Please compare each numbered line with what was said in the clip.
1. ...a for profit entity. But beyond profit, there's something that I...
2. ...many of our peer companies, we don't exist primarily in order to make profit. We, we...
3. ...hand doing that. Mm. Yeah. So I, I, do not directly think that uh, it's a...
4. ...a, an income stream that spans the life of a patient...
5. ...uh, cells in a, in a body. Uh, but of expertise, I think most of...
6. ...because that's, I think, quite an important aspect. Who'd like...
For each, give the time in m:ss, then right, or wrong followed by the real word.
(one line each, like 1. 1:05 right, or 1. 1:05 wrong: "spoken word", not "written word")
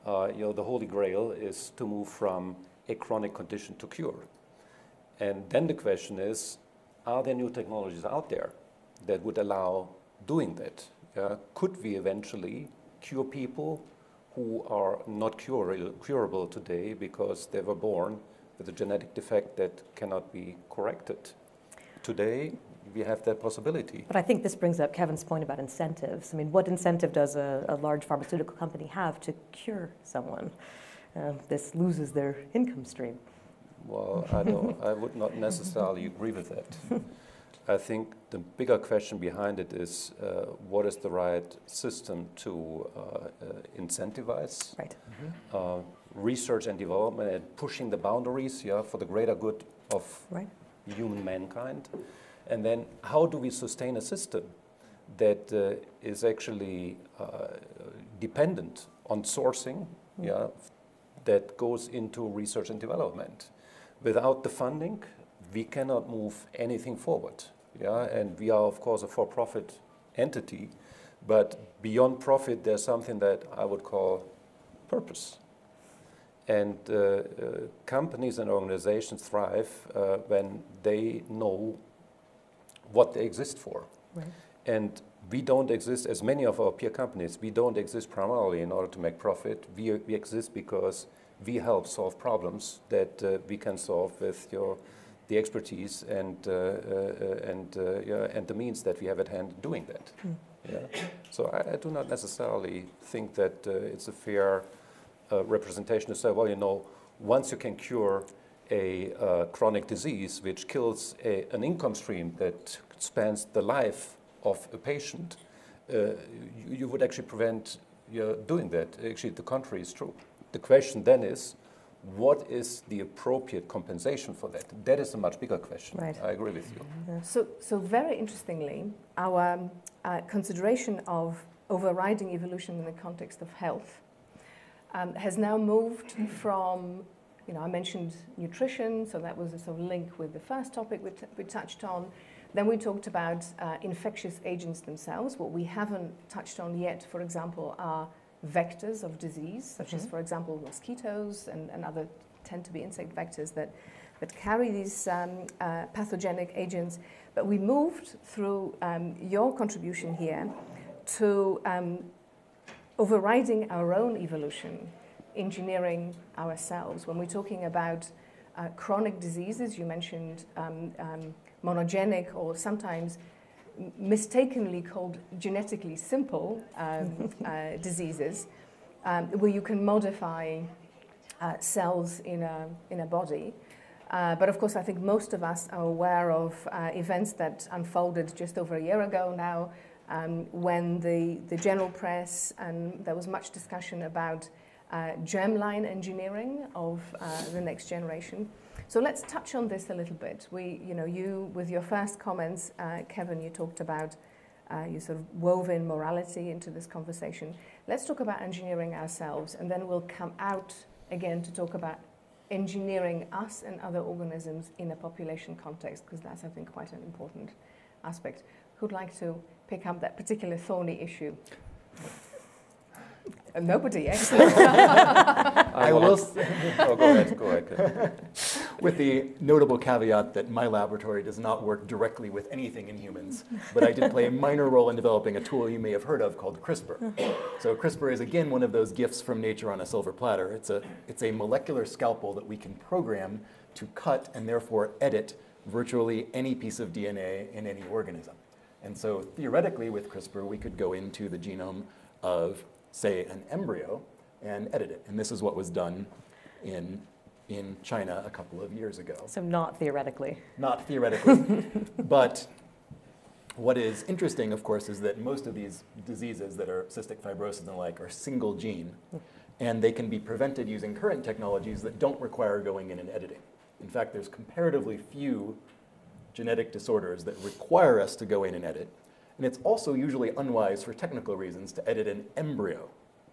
1. 1:09 right
2. 1:26 right
3. 1:39 wrong: "necessarily", not "directly"
4. 1:51 right
5. 3:01 wrong: "course", not "expertise"
6. 3:36 right.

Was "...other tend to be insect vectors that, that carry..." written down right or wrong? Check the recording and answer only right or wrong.
right.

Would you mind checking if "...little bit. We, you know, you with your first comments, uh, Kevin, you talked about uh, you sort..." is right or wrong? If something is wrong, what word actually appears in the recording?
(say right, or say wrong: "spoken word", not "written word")
right.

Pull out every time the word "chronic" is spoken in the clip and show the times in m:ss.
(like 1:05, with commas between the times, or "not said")
0:02, 1:49, 2:48.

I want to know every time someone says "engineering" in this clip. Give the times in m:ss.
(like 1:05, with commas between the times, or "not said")
2:45, 3:15, 3:28, 3:32.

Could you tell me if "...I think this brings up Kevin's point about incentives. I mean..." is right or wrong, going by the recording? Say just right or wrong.
right.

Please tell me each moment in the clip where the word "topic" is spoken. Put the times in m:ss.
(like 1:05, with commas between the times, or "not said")
2:20.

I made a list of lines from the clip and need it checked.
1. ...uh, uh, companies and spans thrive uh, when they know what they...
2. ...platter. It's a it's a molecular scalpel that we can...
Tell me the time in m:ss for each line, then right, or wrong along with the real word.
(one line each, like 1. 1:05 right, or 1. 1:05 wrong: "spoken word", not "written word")
1. 1:16 wrong: "organizations", not "spans"
2. 4:00 right.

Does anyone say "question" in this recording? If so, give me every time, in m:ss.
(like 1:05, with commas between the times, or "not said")
0:05, 0:38, 2:00, 2:05.